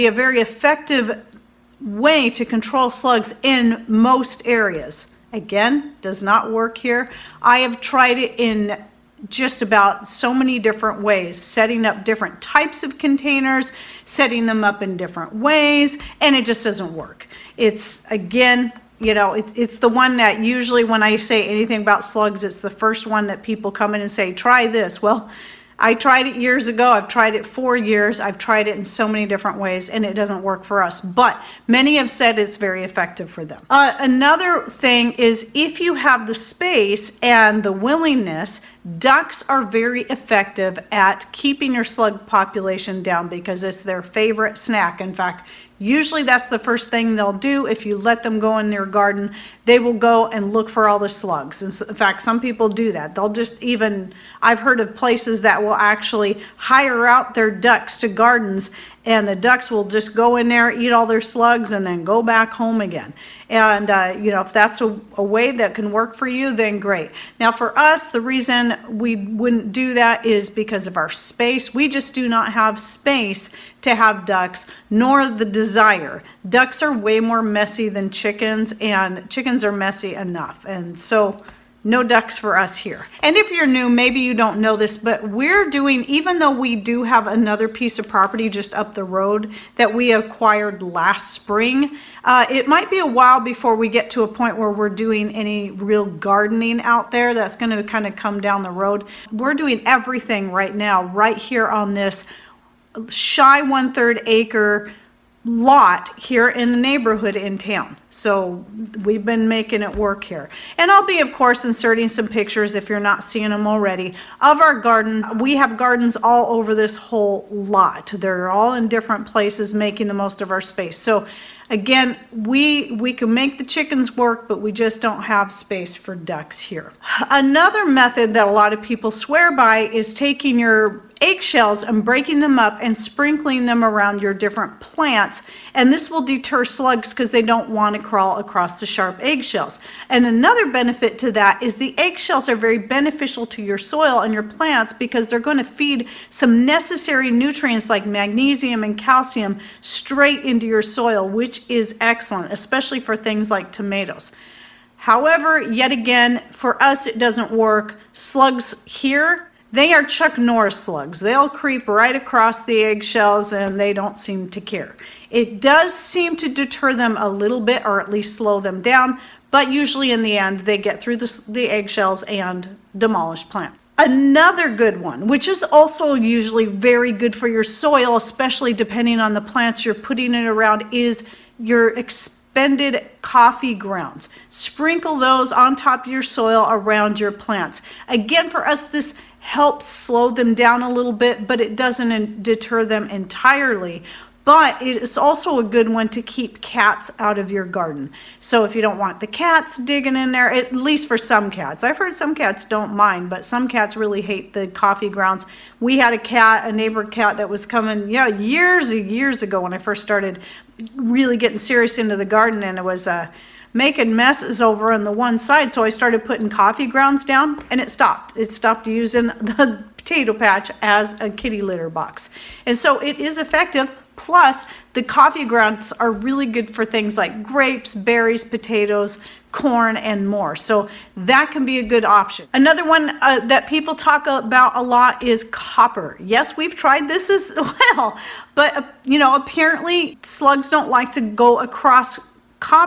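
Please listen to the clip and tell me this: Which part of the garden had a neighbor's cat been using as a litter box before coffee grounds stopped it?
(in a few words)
the potato patch.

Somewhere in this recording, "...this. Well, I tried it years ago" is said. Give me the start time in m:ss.
0:24.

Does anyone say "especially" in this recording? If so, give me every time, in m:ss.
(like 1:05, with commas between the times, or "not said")
2:32, 2:58.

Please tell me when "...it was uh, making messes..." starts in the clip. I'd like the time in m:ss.
3:32.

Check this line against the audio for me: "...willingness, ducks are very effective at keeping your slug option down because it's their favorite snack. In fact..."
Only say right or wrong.
wrong.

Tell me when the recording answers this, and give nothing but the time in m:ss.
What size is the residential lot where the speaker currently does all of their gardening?
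1:43.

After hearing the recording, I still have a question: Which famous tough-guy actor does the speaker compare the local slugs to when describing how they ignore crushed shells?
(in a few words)
Chuck Norris.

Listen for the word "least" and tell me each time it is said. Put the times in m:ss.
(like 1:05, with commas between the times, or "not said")
2:48, 3:20.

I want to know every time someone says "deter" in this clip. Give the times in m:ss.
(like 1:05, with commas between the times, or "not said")
2:16, 2:46, 3:12.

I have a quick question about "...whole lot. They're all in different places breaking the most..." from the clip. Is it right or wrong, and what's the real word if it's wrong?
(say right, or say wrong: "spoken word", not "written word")
wrong: "making", not "breaking".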